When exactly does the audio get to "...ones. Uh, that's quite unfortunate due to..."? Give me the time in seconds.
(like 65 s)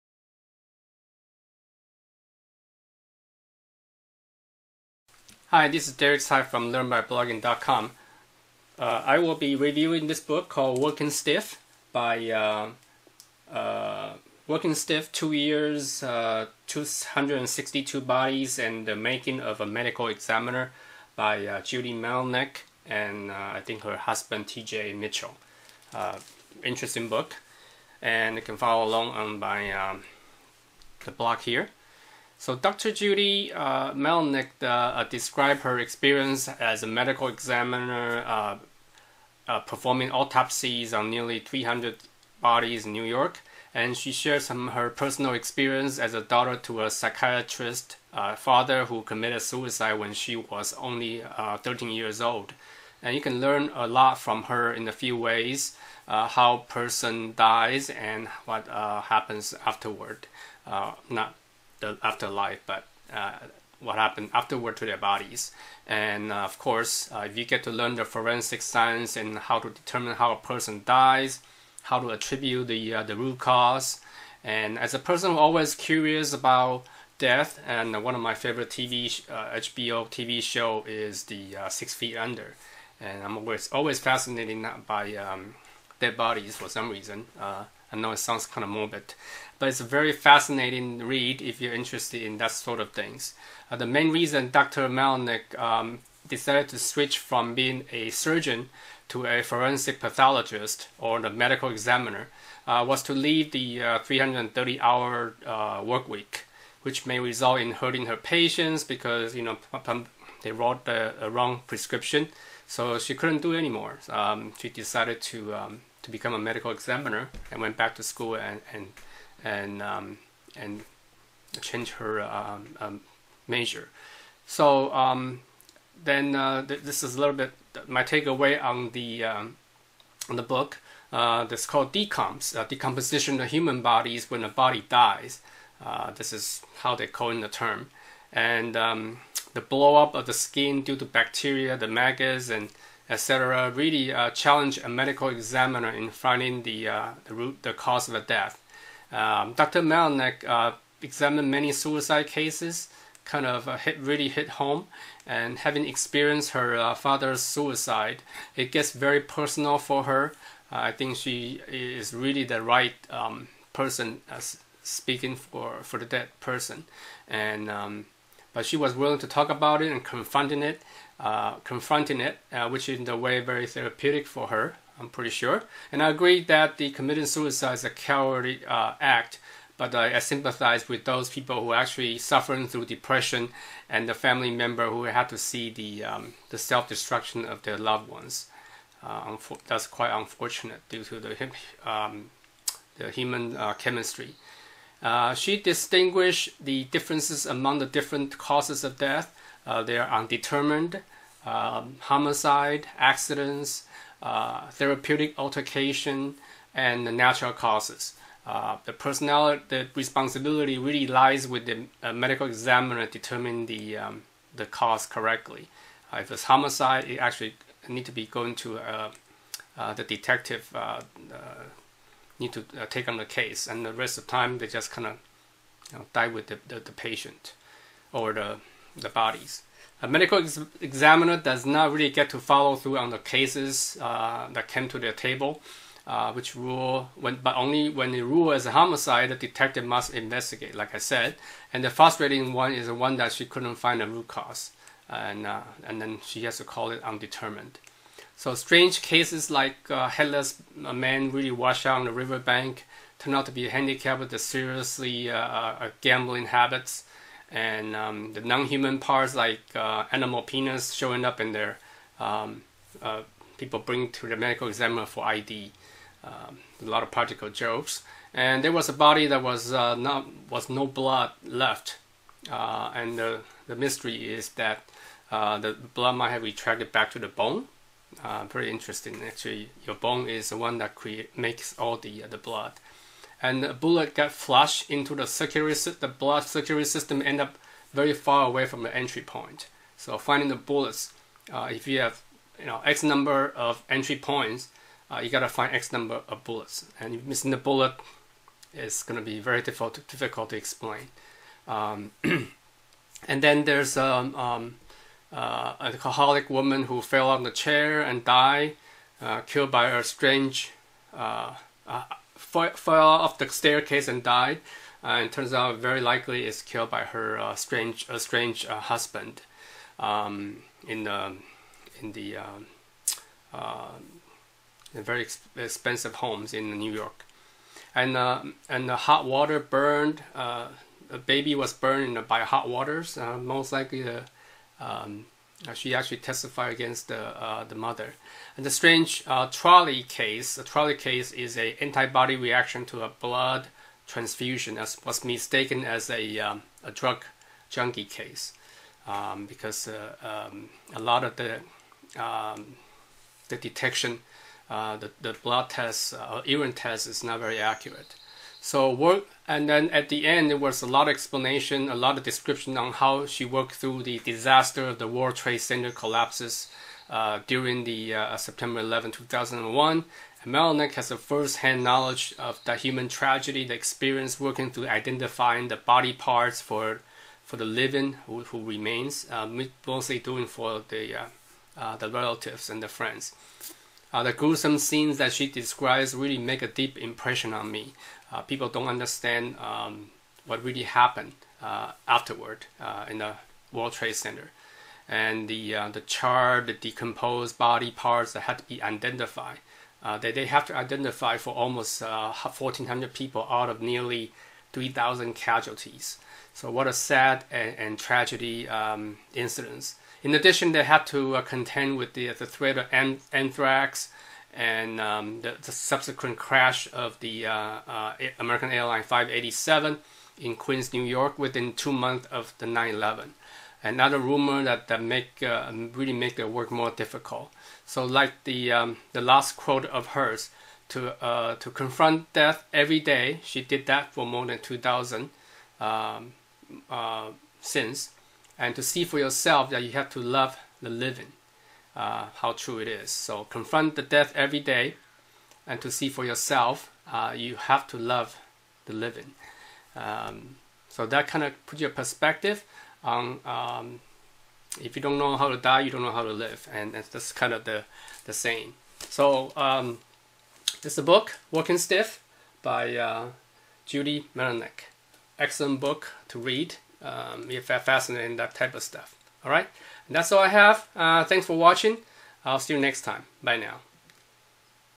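188 s.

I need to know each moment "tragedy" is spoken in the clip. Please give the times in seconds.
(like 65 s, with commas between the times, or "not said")
373 s, 407 s.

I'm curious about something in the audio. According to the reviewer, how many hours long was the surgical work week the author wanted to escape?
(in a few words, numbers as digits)
330.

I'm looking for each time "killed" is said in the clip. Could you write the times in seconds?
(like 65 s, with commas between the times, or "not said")
309 s, 316 s.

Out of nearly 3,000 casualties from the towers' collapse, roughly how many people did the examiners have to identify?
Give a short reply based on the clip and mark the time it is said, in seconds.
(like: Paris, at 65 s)
1,400, at 402 s.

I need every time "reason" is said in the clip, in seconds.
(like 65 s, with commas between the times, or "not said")
86 s, 94 s.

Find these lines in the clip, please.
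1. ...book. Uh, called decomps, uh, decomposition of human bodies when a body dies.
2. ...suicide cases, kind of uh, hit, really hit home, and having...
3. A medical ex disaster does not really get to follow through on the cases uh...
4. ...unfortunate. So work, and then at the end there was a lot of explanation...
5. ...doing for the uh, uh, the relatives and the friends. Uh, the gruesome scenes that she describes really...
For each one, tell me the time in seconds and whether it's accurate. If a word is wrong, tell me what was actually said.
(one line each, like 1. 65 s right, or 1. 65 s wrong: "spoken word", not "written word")
1. 130 s right
2. 151 s right
3. 230 s wrong: "examiner", not "disaster"
4. 357 s wrong: "accurate", not "unfortunate"
5. 380 s right.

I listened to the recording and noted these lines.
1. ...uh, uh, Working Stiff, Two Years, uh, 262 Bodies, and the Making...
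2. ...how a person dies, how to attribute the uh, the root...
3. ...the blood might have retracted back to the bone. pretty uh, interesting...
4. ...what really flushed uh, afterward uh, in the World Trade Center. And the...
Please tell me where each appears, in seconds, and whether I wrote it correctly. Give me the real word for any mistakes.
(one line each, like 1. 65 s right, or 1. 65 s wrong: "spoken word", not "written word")
1. 12 s right
2. 70 s right
3. 275 s right
4. 390 s wrong: "happened", not "flushed".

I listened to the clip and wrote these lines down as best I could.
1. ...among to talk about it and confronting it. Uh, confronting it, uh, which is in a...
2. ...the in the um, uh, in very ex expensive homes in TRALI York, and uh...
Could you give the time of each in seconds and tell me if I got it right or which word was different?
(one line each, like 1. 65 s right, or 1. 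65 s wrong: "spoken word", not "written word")
1. 168 s wrong: "willing", not "among"
2. 321 s wrong: "New", not "TRALI".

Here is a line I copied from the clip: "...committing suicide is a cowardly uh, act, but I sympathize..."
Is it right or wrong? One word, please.
right.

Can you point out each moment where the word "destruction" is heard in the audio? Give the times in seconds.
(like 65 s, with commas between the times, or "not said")
186 s.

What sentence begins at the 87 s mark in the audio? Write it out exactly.
I know it sounds kind of morbid, but it's a very fascinating read if you're interested in that sort of things.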